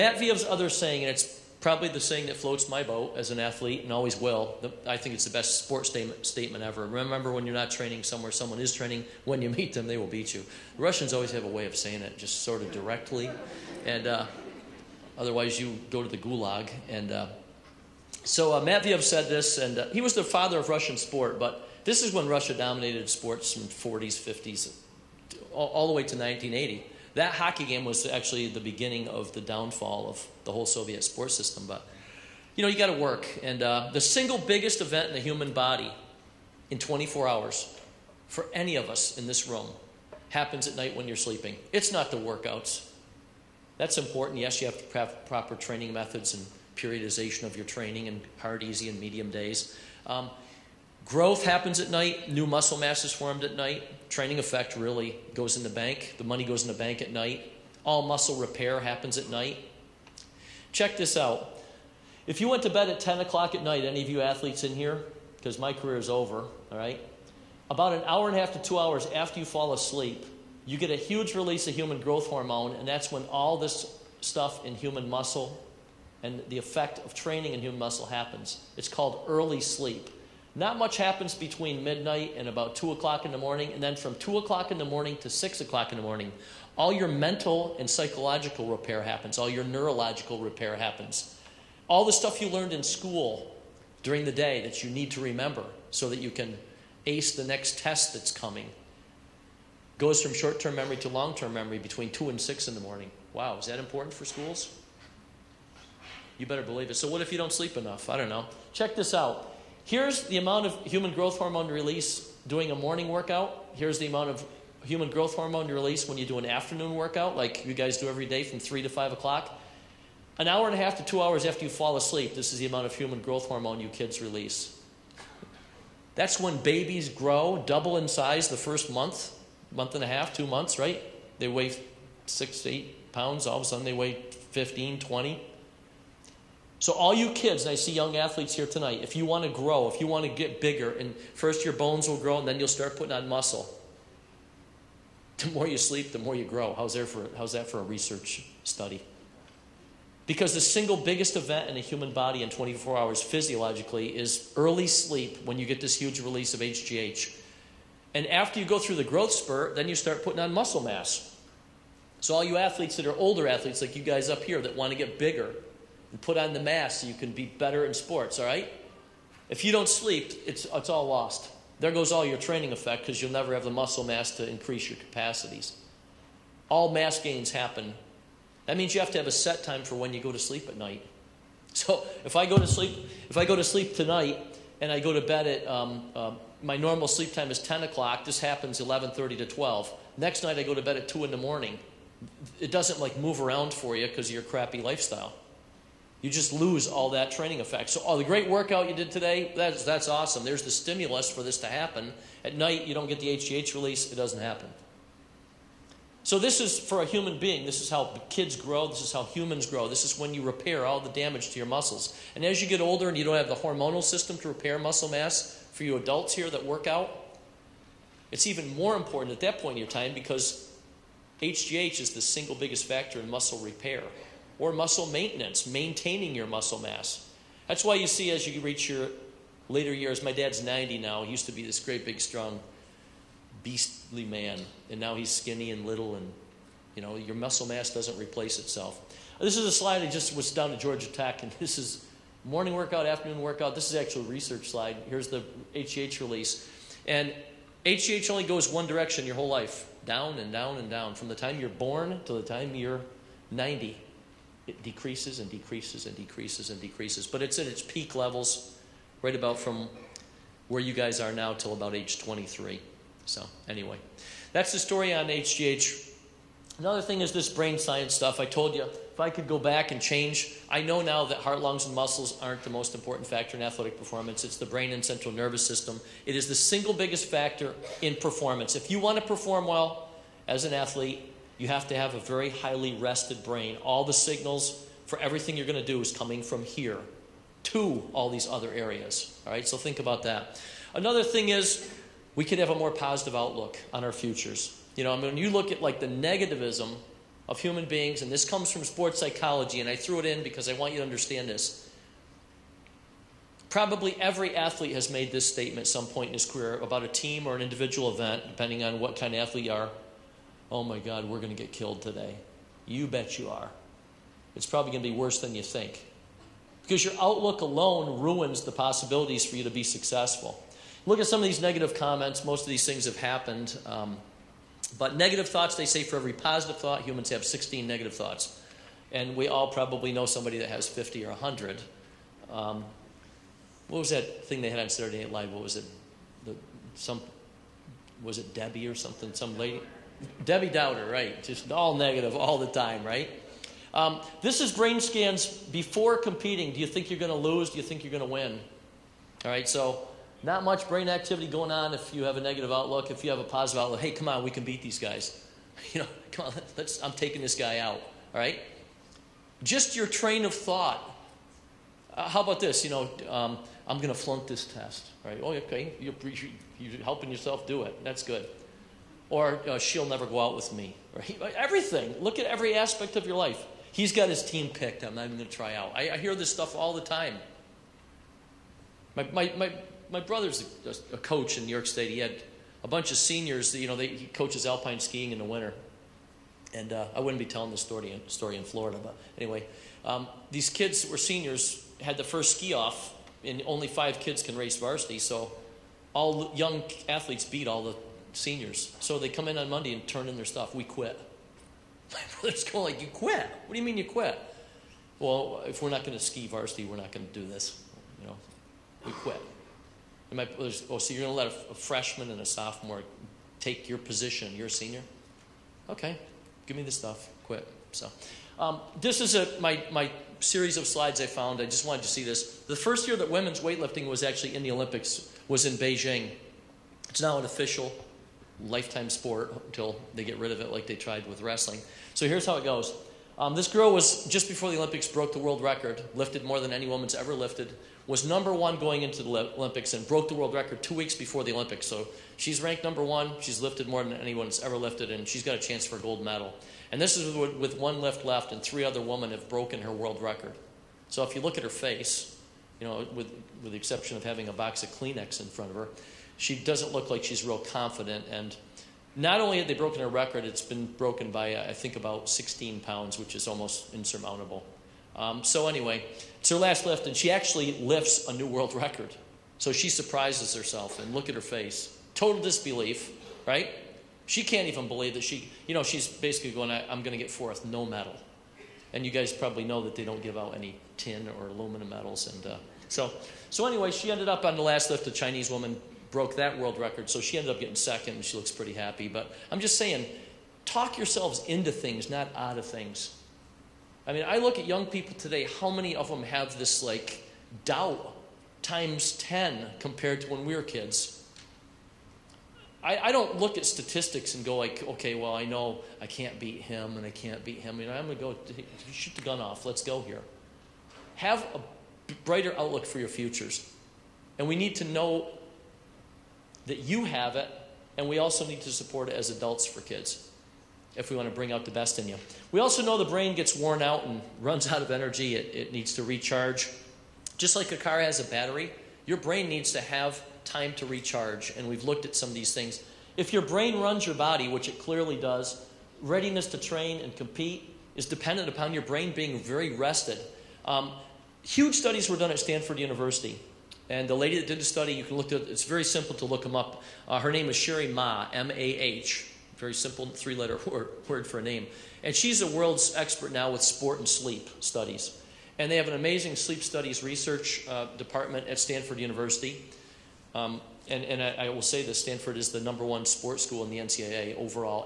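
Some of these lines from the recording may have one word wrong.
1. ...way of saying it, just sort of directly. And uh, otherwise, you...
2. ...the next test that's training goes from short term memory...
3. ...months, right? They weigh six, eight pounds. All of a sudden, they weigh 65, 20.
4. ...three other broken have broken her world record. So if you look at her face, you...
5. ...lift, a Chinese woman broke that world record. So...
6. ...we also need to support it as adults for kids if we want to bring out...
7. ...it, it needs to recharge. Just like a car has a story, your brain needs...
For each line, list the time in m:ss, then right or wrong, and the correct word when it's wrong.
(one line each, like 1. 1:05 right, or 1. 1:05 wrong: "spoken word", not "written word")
1. 0:11 right
2. 1:37 wrong: "coming", not "training"
3. 2:10 wrong: "15", not "65"
4. 7:28 wrong: "women", not "broken"
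5. 8:04 right
6. 8:38 right
7. 8:45 wrong: "battery", not "story".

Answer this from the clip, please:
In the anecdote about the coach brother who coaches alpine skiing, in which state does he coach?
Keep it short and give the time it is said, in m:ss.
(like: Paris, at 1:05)
New York State, at 6:21.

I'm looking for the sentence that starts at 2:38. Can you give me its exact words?
And after you go through the growth spurt, then you start putting on muscle mass.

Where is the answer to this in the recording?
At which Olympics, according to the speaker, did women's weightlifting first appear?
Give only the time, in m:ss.
7:05.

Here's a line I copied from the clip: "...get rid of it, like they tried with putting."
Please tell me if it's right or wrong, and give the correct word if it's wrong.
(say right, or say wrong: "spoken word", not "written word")
wrong: "wrestling", not "putting".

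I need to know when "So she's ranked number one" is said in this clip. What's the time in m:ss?
7:21.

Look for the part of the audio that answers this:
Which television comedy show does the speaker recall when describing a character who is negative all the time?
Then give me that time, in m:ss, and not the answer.
5:34.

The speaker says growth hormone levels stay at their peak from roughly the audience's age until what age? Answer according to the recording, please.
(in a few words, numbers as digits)
23.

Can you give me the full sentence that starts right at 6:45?
Well, if we're not going to ski varsity, we're not going to do this.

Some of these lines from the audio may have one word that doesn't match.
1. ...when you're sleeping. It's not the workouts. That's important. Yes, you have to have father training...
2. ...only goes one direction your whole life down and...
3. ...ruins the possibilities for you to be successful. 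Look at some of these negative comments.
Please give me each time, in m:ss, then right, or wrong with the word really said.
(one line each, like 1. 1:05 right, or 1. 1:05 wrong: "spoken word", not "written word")
1. 0:40 wrong: "proper", not "father"
2. 4:08 right
3. 5:18 right.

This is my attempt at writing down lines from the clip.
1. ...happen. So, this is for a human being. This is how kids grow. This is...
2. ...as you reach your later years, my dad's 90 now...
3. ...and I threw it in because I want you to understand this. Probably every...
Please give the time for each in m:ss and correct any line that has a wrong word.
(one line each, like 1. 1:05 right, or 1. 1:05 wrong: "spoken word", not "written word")
1. 3:24 right
2. 3:48 right
3. 4:59 right.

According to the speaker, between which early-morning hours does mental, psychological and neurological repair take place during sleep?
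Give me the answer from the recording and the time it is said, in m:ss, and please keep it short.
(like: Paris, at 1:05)
2 to 6, at 1:24.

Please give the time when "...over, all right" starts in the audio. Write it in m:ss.
1:06.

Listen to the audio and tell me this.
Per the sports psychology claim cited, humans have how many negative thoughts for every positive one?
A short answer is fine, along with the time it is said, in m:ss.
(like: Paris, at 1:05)
16, at 5:27.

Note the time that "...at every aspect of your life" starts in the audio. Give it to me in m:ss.
6:12.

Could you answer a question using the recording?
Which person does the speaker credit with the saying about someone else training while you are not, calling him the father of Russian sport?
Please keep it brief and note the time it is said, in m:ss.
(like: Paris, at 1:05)
Matveev, at 0:18.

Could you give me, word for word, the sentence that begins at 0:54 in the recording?
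Training effect really goes in the bank.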